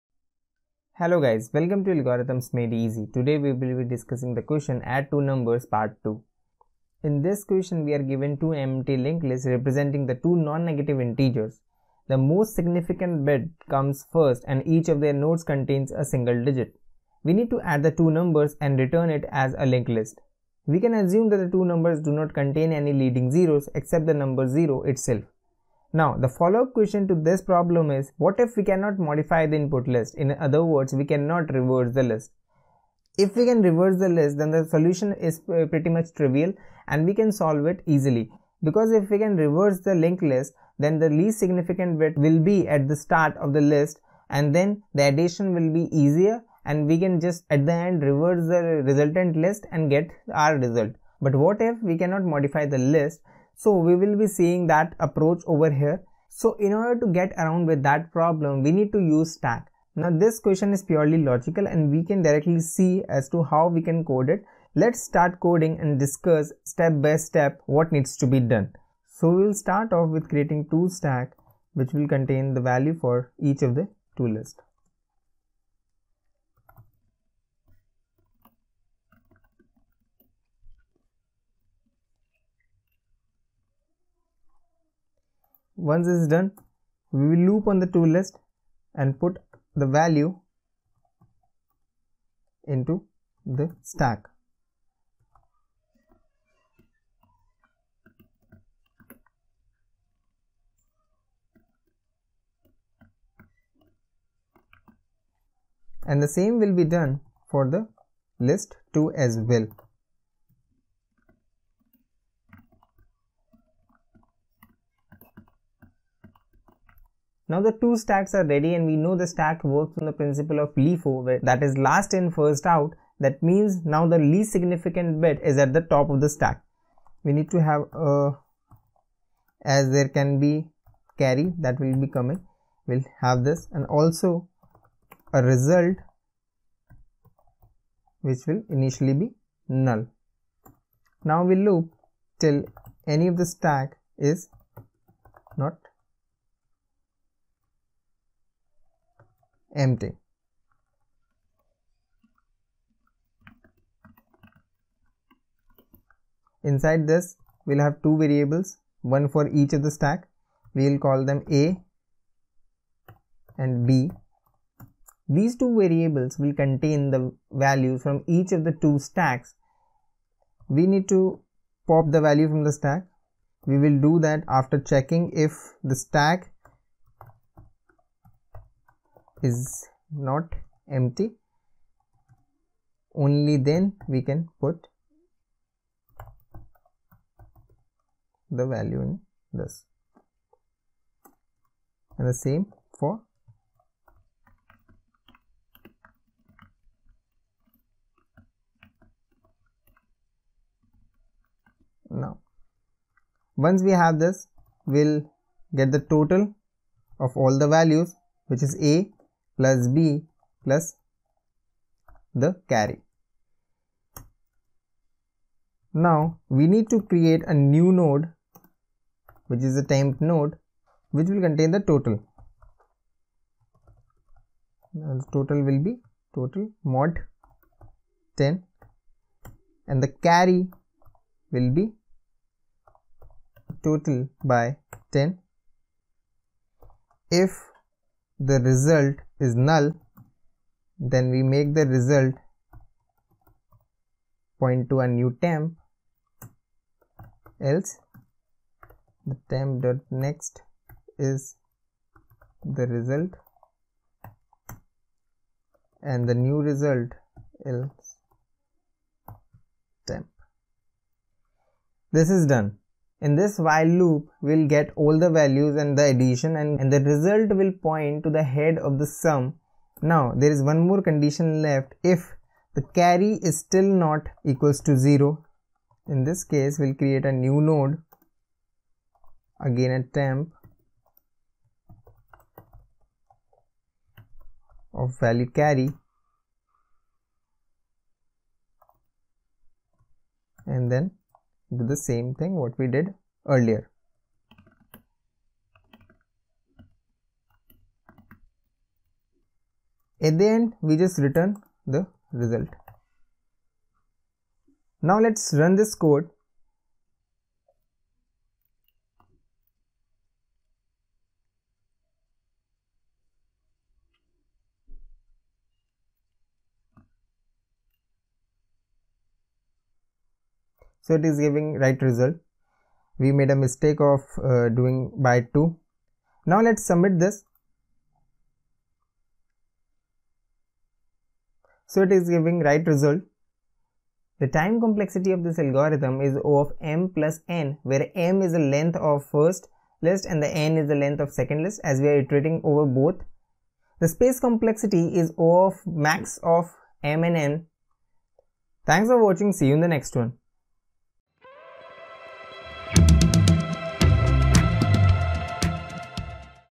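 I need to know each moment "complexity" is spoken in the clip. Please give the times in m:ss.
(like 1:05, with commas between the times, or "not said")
5:34, 5:44.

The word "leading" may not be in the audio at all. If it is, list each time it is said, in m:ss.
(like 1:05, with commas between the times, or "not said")
0:22.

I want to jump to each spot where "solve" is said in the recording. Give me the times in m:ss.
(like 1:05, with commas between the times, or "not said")
0:37.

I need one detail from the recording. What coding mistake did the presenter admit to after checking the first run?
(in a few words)
doing by 2.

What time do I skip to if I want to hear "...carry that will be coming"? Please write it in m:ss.
2:11.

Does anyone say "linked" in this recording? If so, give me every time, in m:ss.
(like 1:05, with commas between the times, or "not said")
0:08, 0:19, 0:39.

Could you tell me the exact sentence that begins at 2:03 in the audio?
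That means now the least significant bit is at the top of the stack.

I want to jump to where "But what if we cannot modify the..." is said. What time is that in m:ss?
0:51.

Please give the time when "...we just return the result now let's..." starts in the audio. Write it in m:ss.
5:00.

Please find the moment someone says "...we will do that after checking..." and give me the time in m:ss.
2:53.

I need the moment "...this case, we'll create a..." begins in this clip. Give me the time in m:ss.
4:36.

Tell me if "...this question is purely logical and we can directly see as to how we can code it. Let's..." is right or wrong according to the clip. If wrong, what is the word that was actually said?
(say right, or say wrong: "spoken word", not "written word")
right.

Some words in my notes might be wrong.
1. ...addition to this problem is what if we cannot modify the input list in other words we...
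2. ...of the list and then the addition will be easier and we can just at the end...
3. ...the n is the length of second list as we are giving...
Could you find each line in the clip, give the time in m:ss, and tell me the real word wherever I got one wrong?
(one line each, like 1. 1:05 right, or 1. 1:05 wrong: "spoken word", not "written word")
1. 0:26 wrong: "question", not "addition"
2. 0:43 right
3. 5:40 wrong: "iterating", not "giving".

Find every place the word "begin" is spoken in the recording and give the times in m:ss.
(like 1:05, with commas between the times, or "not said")
not said.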